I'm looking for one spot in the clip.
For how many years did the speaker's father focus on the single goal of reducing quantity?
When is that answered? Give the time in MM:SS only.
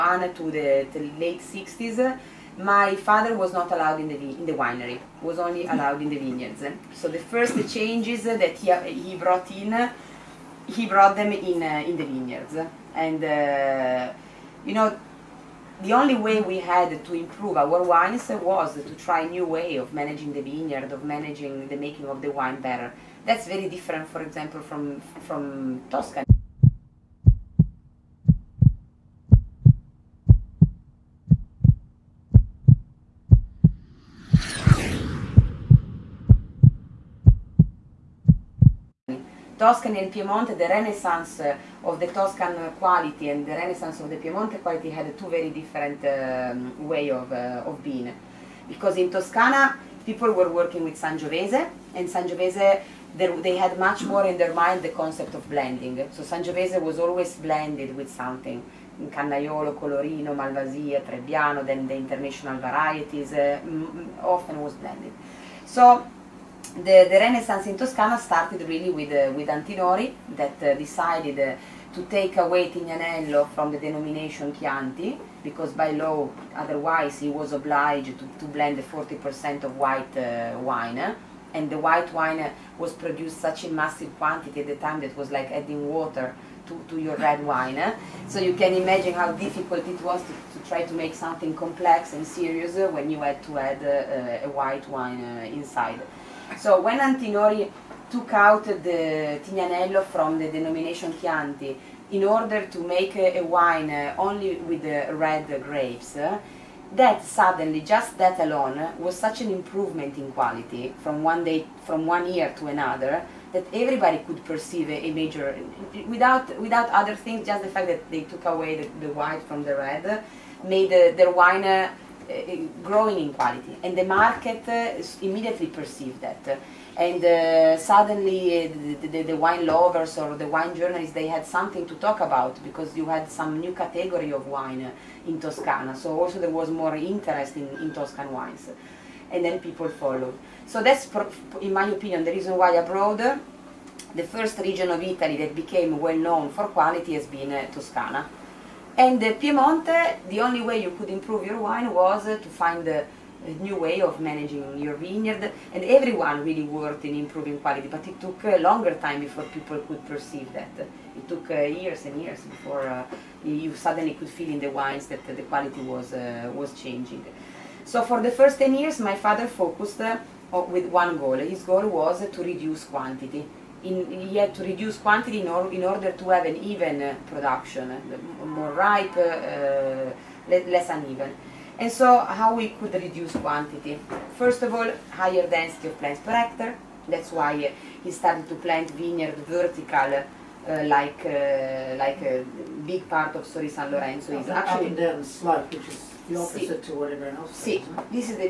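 02:48.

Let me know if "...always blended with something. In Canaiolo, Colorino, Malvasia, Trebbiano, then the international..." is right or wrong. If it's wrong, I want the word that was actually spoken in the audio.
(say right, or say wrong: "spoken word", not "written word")
right.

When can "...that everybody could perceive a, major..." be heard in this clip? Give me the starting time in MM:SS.
01:53.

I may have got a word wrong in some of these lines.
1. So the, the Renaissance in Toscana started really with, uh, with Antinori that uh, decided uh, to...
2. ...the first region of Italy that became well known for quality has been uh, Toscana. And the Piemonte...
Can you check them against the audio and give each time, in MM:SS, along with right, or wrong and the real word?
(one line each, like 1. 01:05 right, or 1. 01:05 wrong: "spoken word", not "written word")
1. 01:05 right
2. 02:24 right.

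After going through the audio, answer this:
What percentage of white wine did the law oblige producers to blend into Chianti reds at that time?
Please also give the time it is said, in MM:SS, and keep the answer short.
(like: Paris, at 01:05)
40%, at 01:18.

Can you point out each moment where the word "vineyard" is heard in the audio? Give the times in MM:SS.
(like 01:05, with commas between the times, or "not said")
00:06, 00:12, 00:20, 02:34, 03:08.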